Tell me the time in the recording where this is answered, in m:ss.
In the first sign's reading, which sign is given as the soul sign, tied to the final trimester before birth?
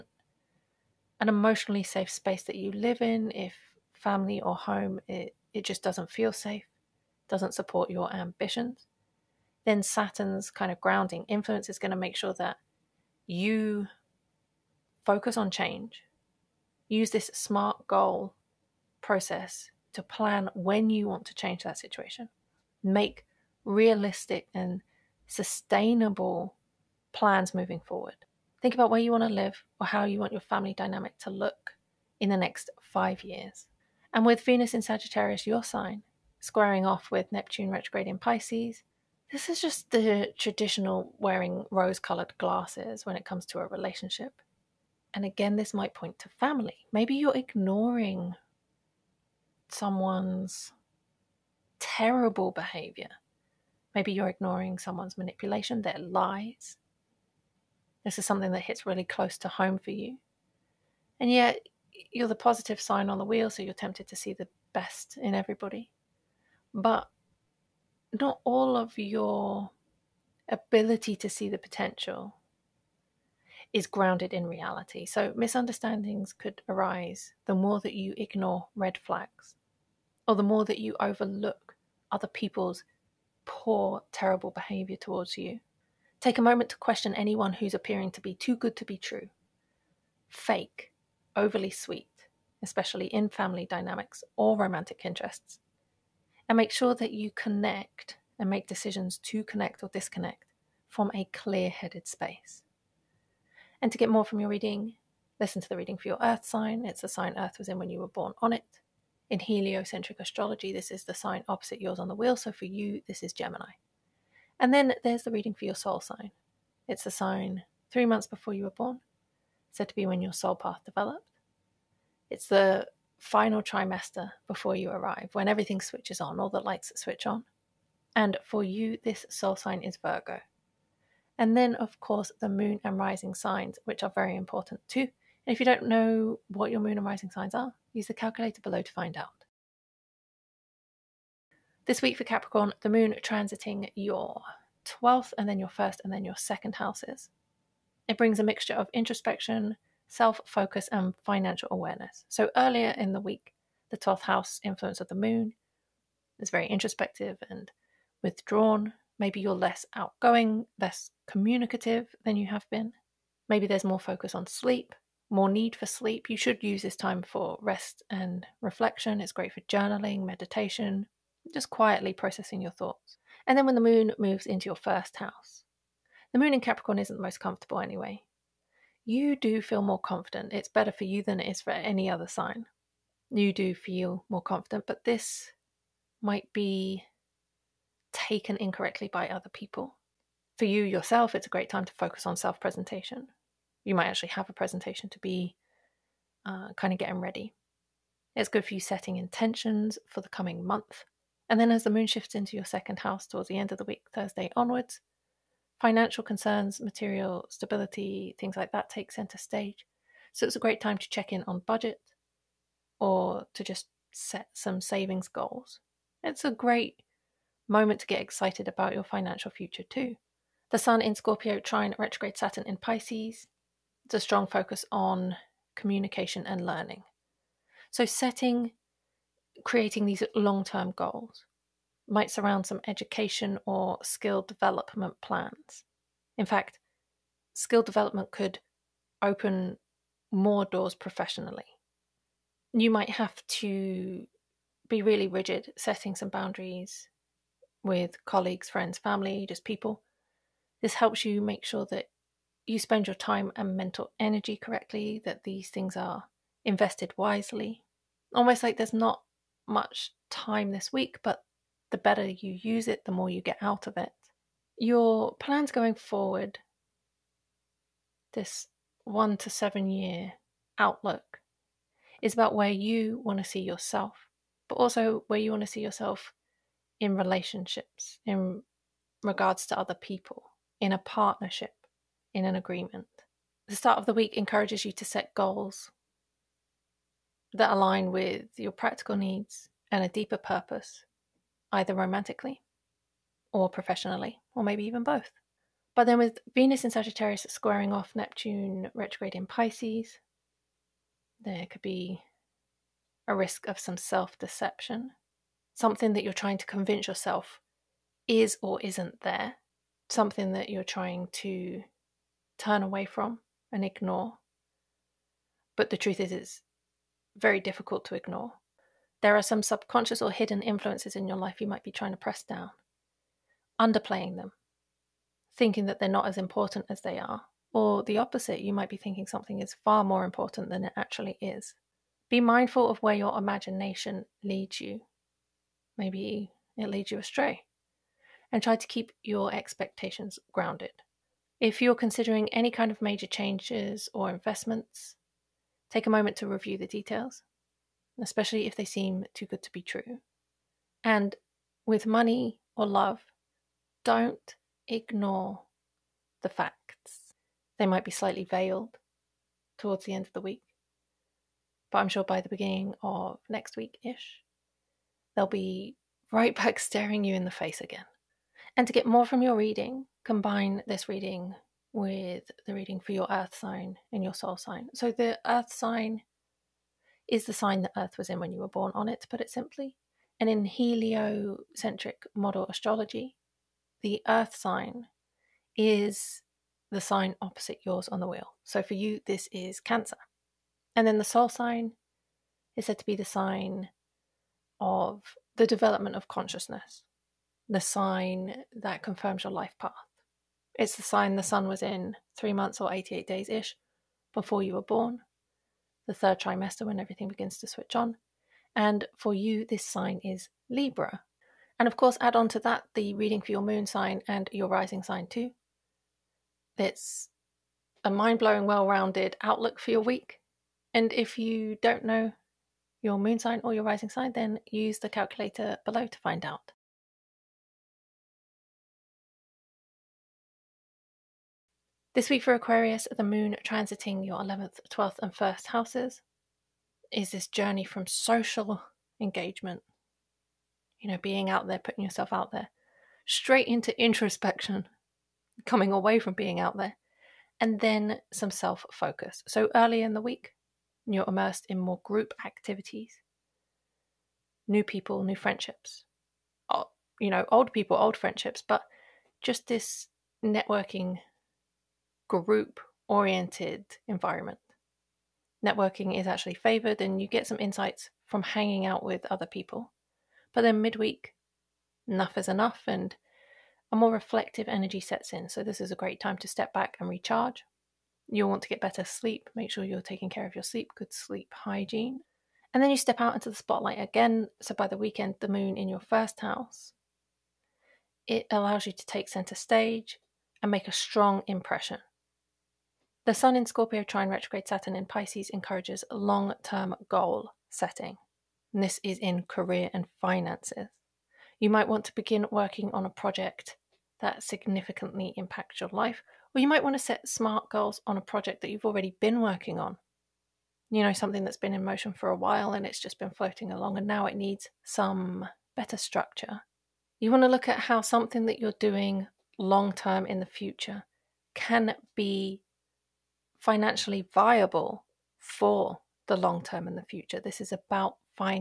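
2:09.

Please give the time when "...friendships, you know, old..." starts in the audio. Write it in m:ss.
7:35.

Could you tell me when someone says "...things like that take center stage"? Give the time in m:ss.
3:28.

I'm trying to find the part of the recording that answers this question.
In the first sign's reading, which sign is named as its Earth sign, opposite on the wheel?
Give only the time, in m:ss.
1:53.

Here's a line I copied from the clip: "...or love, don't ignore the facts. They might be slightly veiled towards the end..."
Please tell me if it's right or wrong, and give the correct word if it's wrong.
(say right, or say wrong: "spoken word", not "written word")
right.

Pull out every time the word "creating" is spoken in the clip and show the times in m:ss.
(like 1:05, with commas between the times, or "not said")
3:49.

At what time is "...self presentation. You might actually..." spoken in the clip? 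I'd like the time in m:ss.
3:12.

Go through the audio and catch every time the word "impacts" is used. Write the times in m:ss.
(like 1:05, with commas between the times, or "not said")
8:25.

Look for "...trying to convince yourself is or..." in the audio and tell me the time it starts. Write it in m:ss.
5:06.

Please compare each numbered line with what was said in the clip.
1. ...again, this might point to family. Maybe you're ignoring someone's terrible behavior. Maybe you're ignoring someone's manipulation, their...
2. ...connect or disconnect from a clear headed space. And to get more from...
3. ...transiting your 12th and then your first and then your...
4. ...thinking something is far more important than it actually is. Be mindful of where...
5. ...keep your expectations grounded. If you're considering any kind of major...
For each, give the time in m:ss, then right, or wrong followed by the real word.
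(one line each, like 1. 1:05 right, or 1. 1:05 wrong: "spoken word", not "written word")
1. 0:45 right
2. 1:39 right
3. 2:23 right
4. 5:28 right
5. 5:38 right.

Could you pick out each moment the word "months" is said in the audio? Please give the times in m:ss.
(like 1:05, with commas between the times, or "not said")
1:58, 3:20, 6:42.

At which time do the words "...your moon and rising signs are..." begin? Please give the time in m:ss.
2:16.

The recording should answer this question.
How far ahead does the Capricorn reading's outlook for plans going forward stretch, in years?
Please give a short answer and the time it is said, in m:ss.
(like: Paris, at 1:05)
1 to 7 years, at 4:29.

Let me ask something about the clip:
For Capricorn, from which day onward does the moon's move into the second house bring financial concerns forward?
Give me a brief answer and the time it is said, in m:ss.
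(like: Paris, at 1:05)
Thursday, at 3:24.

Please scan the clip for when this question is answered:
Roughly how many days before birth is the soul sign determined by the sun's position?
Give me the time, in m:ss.
6:42.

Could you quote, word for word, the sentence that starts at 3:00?
It's better for you than it is for any other sign.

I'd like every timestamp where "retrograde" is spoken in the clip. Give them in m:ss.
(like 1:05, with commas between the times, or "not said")
0:37, 3:41, 4:58, 8:14.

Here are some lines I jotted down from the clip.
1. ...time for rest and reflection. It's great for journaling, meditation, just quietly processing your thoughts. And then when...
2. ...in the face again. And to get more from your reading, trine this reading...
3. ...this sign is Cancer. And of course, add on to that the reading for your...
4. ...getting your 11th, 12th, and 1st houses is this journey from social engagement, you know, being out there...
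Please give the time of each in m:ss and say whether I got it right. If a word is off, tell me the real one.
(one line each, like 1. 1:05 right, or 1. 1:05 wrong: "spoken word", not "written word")
1. 2:46 right
2. 6:07 wrong: "combine", not "trine"
3. 6:49 wrong: "Libra", not "Cancer"
4. 7:13 wrong: "transiting", not "getting".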